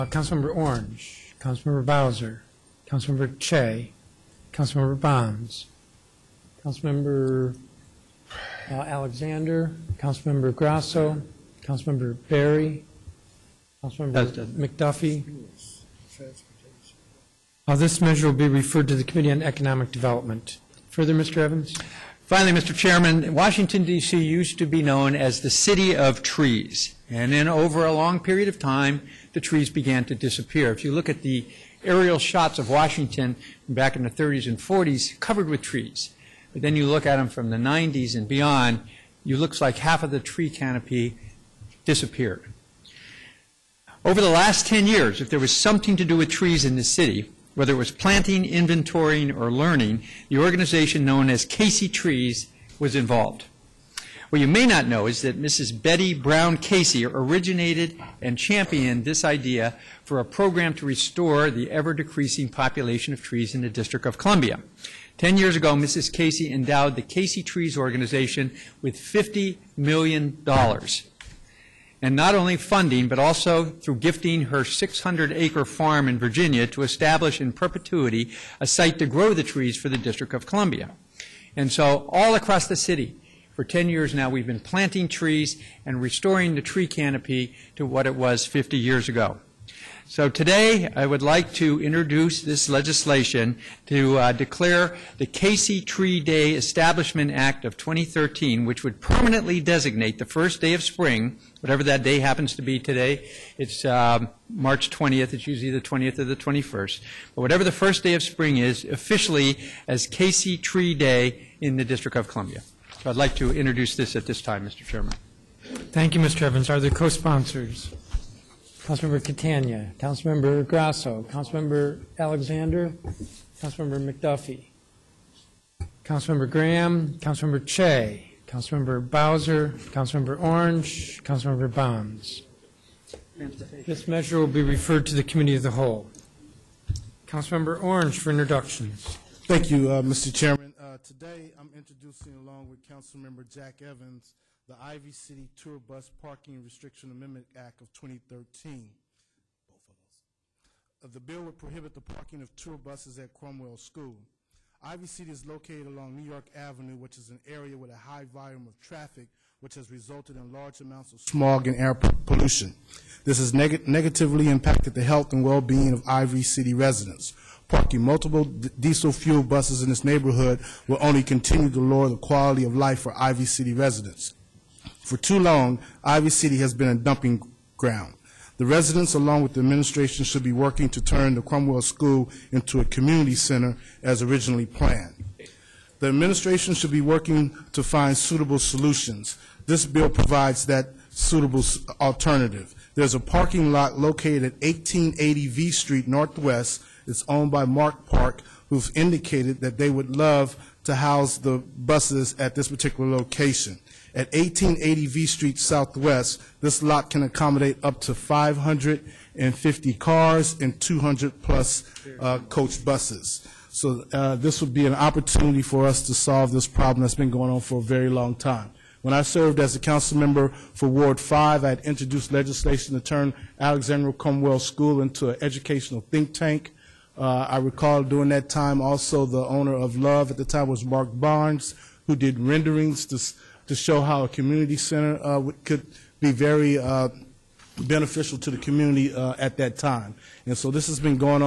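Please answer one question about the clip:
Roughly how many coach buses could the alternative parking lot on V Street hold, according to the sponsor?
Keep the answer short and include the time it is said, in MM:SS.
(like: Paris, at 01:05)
200-plus, at 03:30.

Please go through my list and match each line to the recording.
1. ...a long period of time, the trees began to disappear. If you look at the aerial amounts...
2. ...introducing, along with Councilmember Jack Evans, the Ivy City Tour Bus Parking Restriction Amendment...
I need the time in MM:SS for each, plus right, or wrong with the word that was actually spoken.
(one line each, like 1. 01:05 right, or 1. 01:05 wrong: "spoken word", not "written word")
1. 00:27 wrong: "shots", not "amounts"
2. 02:21 right.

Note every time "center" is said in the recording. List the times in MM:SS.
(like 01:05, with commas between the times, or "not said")
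03:03, 03:54.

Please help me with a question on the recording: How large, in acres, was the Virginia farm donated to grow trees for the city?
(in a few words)
600 acres.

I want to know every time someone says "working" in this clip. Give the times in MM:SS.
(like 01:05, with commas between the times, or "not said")
03:00, 03:06.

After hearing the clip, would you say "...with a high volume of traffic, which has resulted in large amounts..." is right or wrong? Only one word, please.
right.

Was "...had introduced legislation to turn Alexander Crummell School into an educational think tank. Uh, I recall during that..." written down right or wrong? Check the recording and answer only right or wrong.
right.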